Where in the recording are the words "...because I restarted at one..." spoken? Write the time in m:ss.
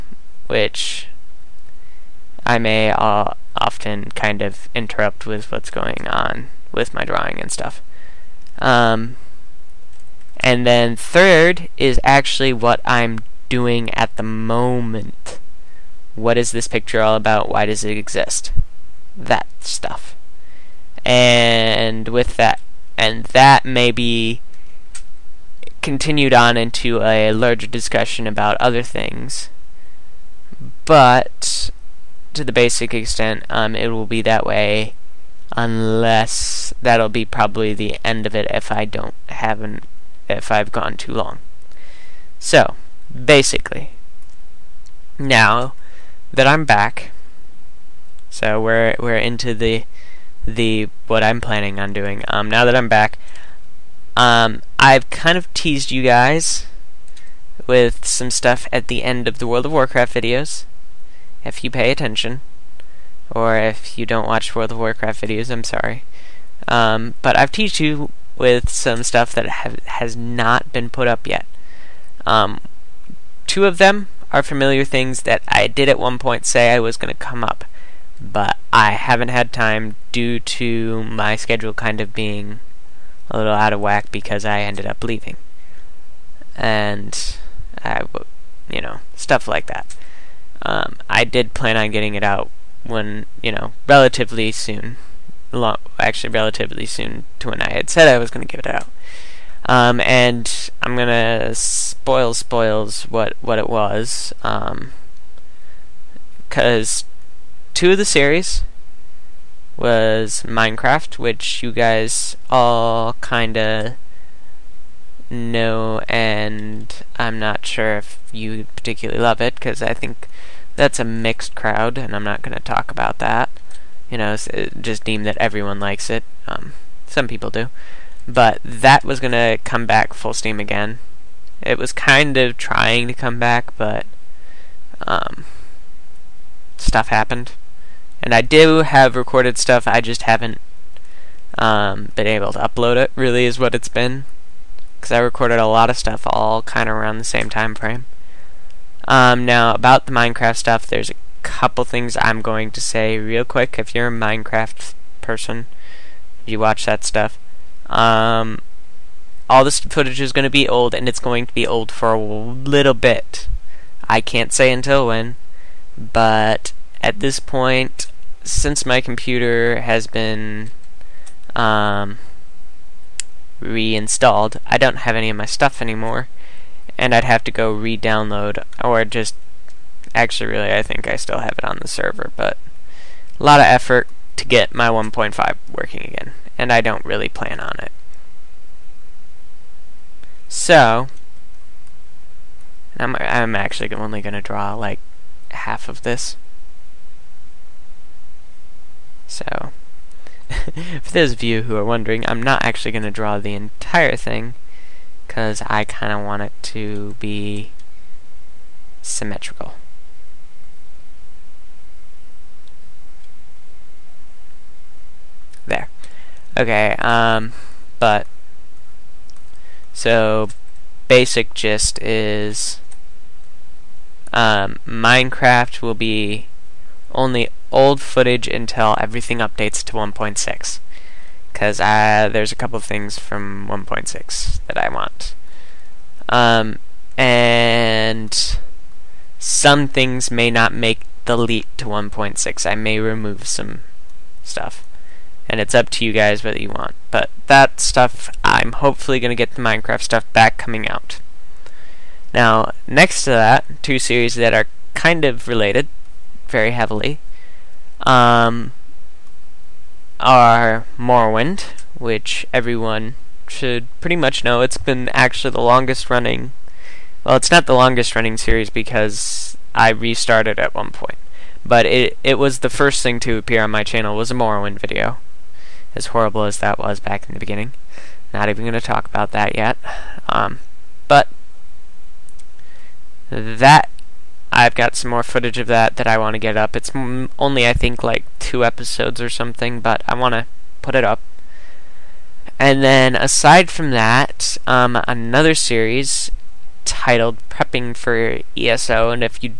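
4:28.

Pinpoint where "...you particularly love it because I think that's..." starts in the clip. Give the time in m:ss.
1:58.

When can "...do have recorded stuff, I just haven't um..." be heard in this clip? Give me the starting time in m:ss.
2:18.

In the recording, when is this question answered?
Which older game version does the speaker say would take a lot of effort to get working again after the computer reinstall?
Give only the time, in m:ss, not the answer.
3:04.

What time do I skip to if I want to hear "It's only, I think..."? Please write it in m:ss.
4:46.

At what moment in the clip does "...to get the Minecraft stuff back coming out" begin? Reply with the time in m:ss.
4:09.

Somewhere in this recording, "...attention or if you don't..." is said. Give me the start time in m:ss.
1:01.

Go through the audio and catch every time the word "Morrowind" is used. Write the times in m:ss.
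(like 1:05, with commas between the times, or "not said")
4:20, 4:34.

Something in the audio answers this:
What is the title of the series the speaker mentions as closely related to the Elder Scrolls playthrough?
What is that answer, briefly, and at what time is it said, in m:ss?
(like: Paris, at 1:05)
Prepping for ESO, at 4:57.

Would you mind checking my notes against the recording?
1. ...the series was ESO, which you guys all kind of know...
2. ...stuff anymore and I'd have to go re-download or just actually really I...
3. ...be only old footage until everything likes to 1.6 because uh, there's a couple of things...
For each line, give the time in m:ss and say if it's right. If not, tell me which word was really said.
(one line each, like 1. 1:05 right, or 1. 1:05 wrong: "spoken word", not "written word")
1. 1:47 wrong: "Minecraft", not "ESO"
2. 2:55 right
3. 3:45 wrong: "updates", not "likes".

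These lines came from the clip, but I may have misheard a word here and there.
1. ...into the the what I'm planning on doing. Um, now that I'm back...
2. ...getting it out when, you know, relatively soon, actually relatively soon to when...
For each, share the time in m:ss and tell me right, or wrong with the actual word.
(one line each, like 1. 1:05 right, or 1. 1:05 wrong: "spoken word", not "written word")
1. 0:49 right
2. 1:31 right.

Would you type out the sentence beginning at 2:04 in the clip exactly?
You know, uh, just deem that everyone likes it.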